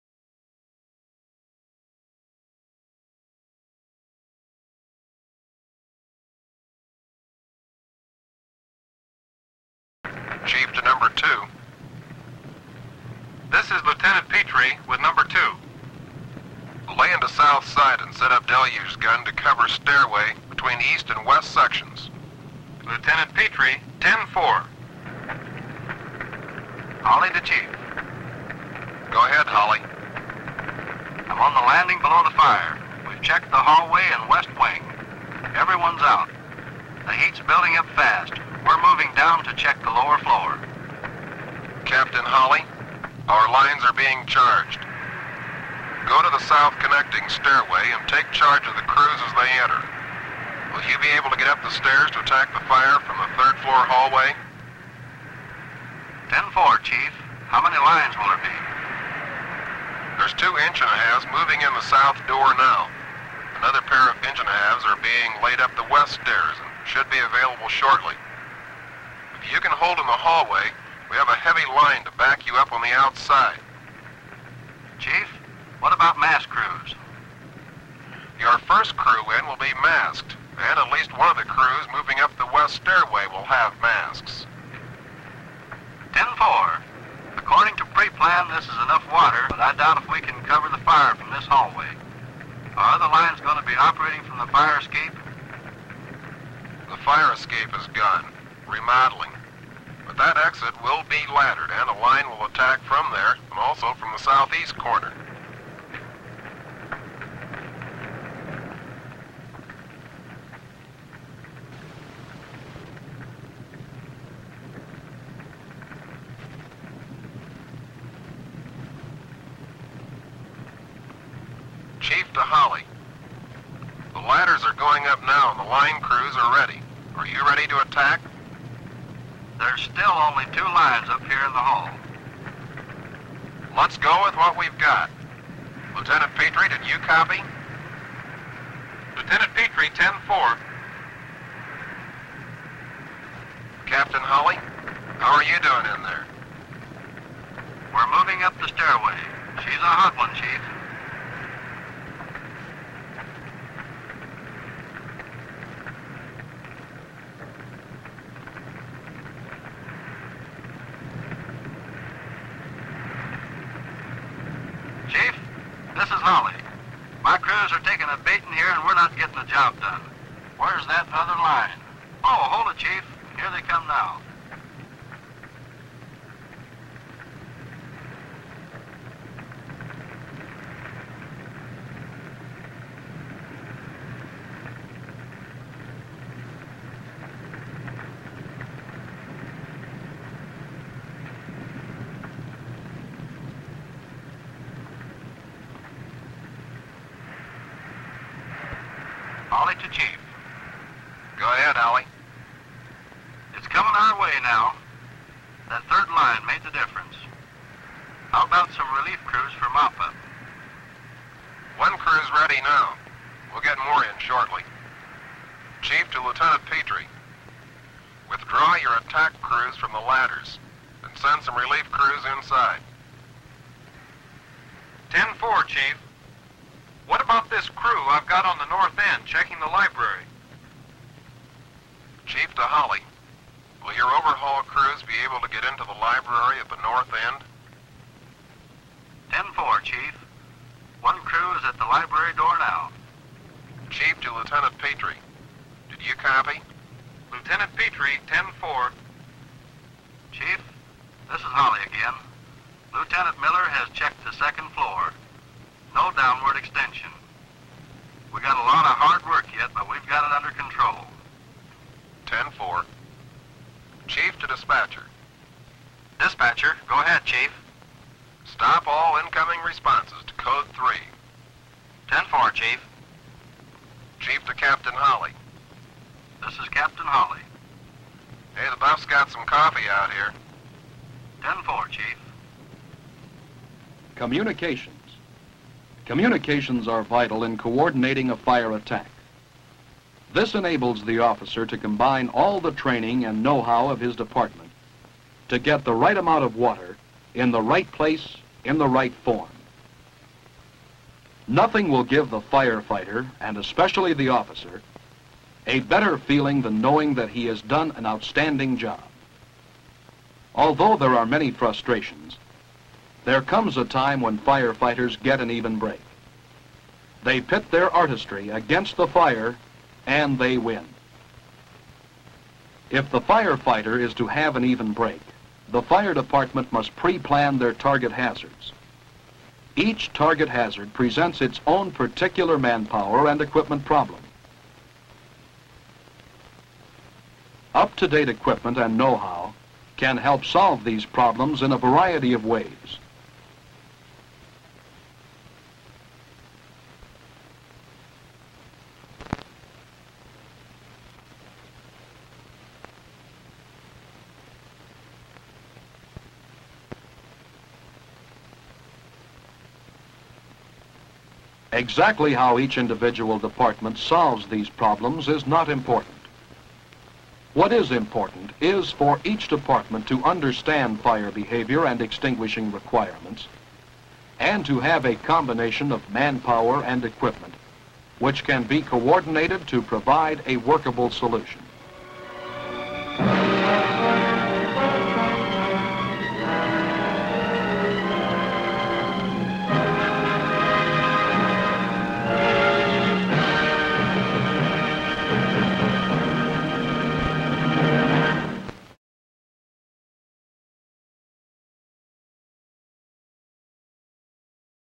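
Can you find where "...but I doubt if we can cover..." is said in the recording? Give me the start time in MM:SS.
01:29.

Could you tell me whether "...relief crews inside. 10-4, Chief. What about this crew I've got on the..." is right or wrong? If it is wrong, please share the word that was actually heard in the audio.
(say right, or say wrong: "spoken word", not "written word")
right.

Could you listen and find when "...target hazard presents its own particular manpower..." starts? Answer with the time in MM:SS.
05:30.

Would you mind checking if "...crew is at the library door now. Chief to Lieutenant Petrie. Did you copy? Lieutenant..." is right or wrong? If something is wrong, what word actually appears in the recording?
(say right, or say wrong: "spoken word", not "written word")
right.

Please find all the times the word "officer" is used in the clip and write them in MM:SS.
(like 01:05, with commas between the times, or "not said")
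04:51, 05:04.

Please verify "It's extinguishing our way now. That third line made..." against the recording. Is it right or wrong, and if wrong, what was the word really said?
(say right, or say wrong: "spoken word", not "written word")
wrong: "coming", not "extinguishing".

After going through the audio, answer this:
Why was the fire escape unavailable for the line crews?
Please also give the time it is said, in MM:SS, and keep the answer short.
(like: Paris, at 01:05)
Remodeling, at 01:38.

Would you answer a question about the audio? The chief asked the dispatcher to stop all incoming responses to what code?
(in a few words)
Code 3.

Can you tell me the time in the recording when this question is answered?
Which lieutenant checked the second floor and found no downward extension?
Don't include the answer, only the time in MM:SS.
04:12.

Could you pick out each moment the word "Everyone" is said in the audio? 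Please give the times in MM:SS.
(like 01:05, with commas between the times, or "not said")
00:35.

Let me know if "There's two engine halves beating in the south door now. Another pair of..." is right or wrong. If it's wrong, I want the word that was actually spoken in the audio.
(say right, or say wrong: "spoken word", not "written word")
wrong: "moving", not "beating".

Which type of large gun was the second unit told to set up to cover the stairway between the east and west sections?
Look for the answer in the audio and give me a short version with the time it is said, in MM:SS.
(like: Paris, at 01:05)
Deluge gun, at 00:18.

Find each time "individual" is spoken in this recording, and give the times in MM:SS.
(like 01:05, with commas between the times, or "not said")
06:02.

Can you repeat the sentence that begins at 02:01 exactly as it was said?
Chief Holly, the ladders are going up now and the line crews are ready.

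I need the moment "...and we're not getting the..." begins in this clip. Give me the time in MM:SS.
02:48.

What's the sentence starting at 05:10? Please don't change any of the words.
Although there are many frustrations, there comes a time when firefighters get an even break.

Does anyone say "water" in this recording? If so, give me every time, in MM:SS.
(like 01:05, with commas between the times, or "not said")
01:29, 04:56.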